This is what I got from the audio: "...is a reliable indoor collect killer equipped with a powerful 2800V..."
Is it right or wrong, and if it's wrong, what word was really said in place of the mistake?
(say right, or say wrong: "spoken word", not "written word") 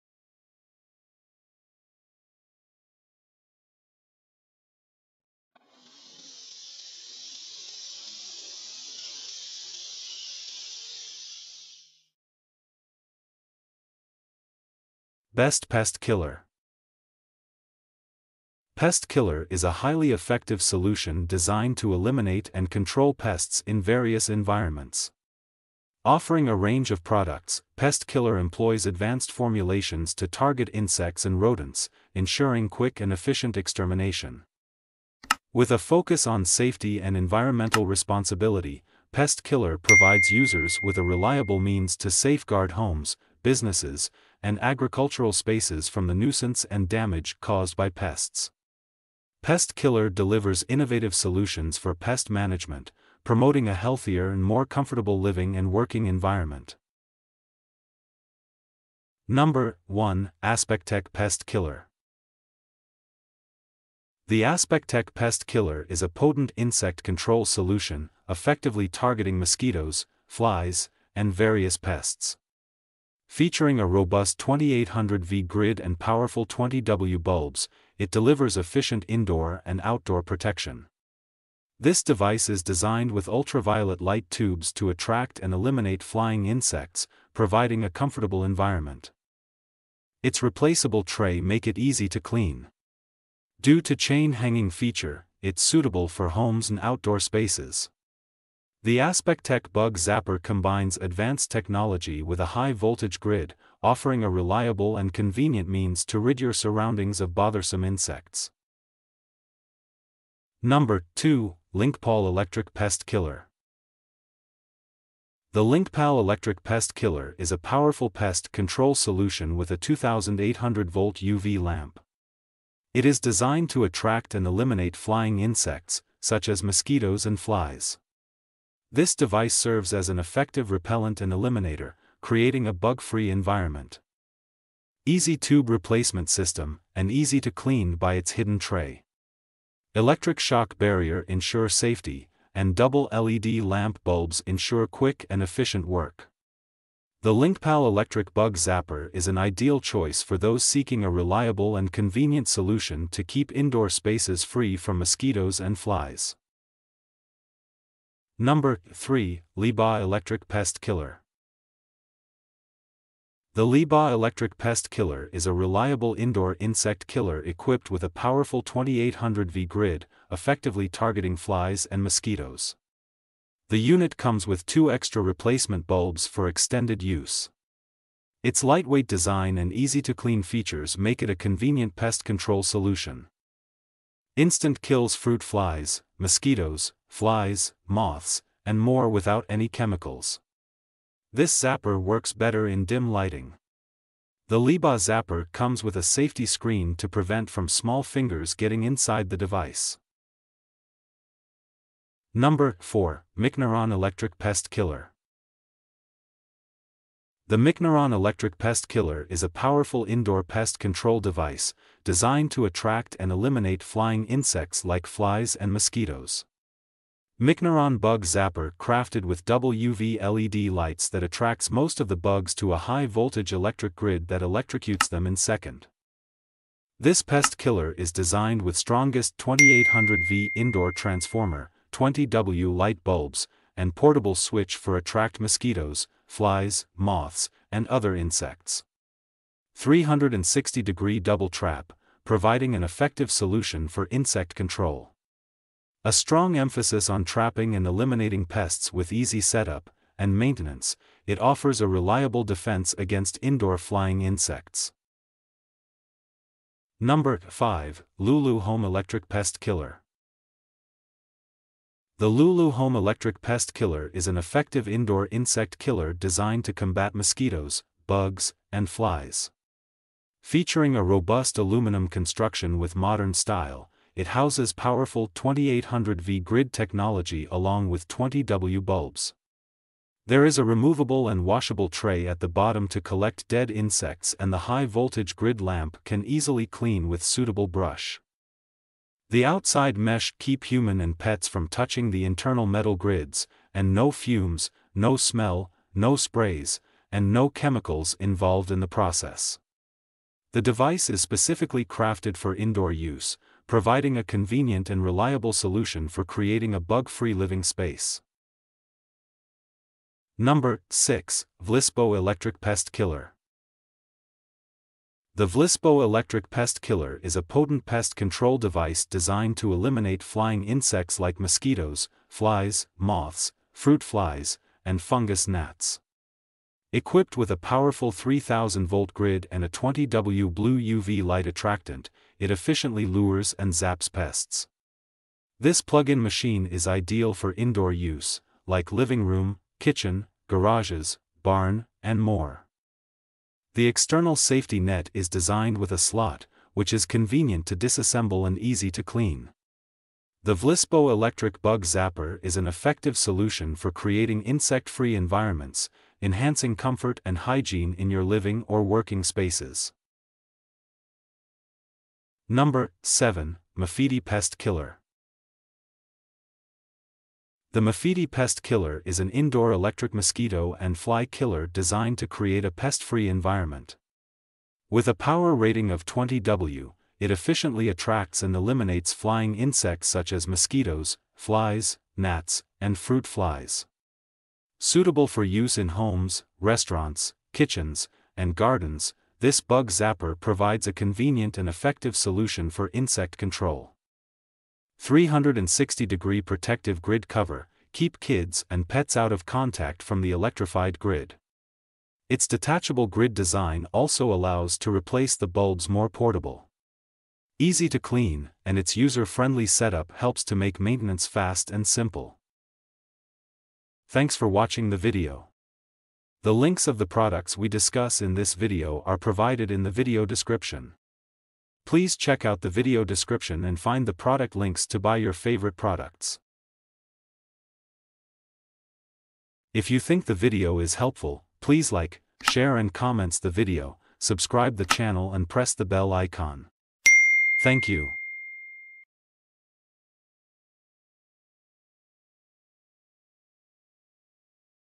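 wrong: "insect", not "collect".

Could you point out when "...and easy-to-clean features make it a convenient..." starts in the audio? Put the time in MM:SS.
02:59.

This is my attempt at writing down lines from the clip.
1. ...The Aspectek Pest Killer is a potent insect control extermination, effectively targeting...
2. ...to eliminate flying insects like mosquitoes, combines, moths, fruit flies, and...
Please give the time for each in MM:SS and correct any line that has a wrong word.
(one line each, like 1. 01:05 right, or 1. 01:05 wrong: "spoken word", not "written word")
1. 01:04 wrong: "solution", not "extermination"
2. 05:19 wrong: "flies", not "combines".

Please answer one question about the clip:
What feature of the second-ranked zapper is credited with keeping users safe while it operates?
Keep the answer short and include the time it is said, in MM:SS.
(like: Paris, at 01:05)
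Electric shock barrier, at 02:19.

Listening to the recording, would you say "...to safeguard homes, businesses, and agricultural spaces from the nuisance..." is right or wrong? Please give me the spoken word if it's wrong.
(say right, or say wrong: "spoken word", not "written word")
right.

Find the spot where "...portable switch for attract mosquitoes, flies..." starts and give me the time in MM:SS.
03:53.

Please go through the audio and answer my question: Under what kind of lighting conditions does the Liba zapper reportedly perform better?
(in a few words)
Dim lighting.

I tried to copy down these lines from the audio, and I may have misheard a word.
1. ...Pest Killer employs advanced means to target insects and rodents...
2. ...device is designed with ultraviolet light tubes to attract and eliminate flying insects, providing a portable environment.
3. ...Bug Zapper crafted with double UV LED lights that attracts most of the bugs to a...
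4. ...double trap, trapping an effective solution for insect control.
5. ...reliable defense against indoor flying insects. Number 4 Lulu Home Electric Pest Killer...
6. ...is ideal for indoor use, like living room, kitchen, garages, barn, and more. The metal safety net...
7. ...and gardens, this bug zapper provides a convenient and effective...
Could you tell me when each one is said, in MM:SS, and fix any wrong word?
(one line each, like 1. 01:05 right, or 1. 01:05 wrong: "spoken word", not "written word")
1. 00:27 wrong: "formulations", not "means"
2. 01:22 wrong: "comfortable", not "portable"
3. 03:37 right
4. 04:01 wrong: "providing", not "trapping"
5. 04:11 wrong: "5", not "4"
6. 05:36 wrong: "external", not "metal"
7. 06:28 right.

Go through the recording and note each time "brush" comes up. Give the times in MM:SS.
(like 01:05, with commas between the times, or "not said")
04:47.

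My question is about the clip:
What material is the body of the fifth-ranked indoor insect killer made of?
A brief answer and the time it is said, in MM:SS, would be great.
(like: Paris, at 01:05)
Aluminum, at 04:31.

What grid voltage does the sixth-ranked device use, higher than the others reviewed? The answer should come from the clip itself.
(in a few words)
3000 volts.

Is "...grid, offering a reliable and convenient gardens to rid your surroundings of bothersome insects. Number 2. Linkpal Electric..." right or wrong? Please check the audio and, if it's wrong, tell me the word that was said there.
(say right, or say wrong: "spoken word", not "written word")
wrong: "means", not "gardens".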